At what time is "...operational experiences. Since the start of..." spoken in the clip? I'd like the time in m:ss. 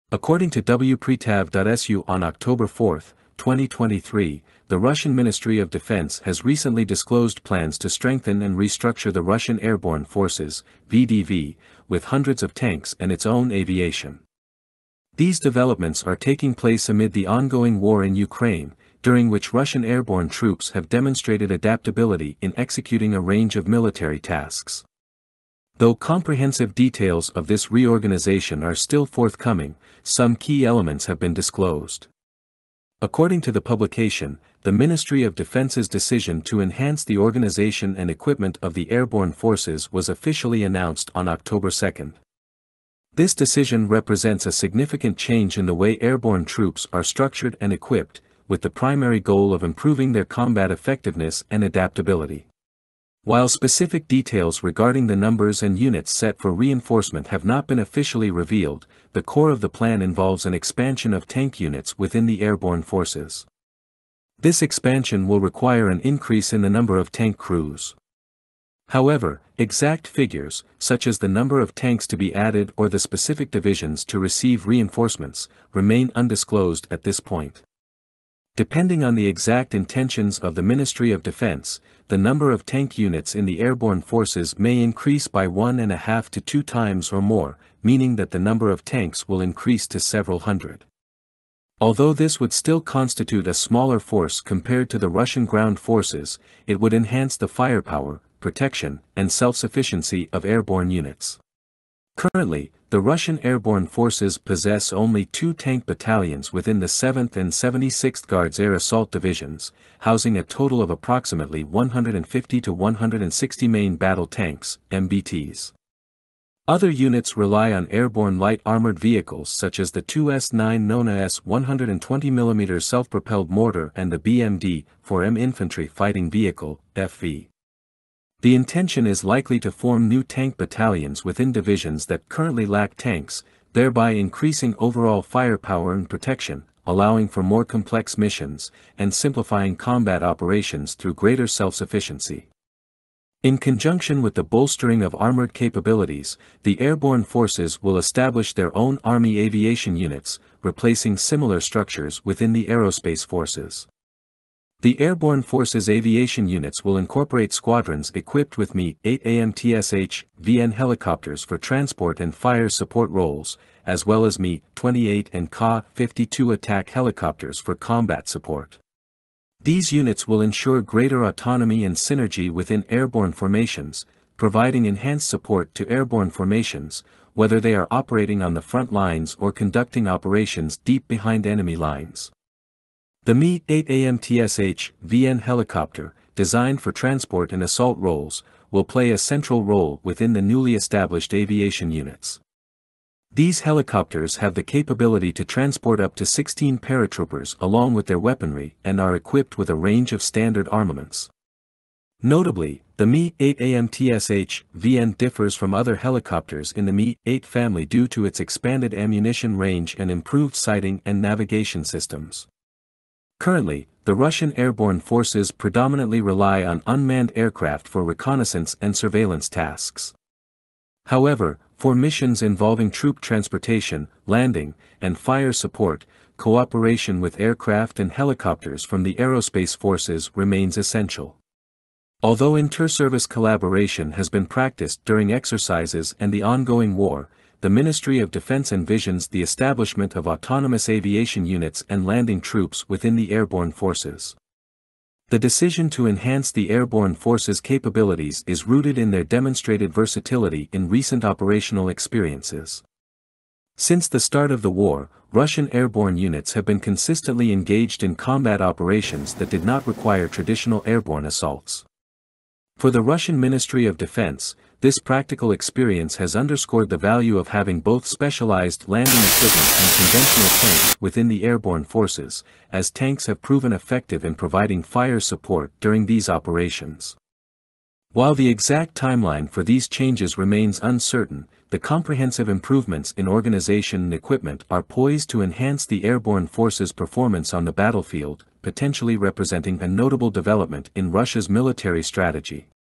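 4:11.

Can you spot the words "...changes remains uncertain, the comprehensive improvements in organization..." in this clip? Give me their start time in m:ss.
4:39.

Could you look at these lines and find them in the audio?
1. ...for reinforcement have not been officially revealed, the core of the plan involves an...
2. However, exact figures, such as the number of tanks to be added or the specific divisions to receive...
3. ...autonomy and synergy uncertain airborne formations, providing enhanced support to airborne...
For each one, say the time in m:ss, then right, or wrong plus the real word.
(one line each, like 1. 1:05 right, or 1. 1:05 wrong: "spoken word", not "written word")
1. 0:56 right
2. 1:08 right
3. 2:51 wrong: "within", not "uncertain".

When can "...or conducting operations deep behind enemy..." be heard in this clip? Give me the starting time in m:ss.
2:59.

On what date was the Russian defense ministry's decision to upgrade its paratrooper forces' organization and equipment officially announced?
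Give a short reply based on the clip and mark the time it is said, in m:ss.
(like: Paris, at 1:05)
October 2, at 0:41.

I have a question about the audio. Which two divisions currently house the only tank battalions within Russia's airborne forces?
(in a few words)
7th and 76th.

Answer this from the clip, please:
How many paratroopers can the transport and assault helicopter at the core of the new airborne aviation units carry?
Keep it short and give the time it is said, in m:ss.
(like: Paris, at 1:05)
16, at 3:16.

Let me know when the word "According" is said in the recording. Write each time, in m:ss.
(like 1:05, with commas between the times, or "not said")
0:00, 0:33.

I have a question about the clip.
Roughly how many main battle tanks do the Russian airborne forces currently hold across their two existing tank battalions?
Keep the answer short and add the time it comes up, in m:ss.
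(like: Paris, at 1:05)
150 to 160, at 1:51.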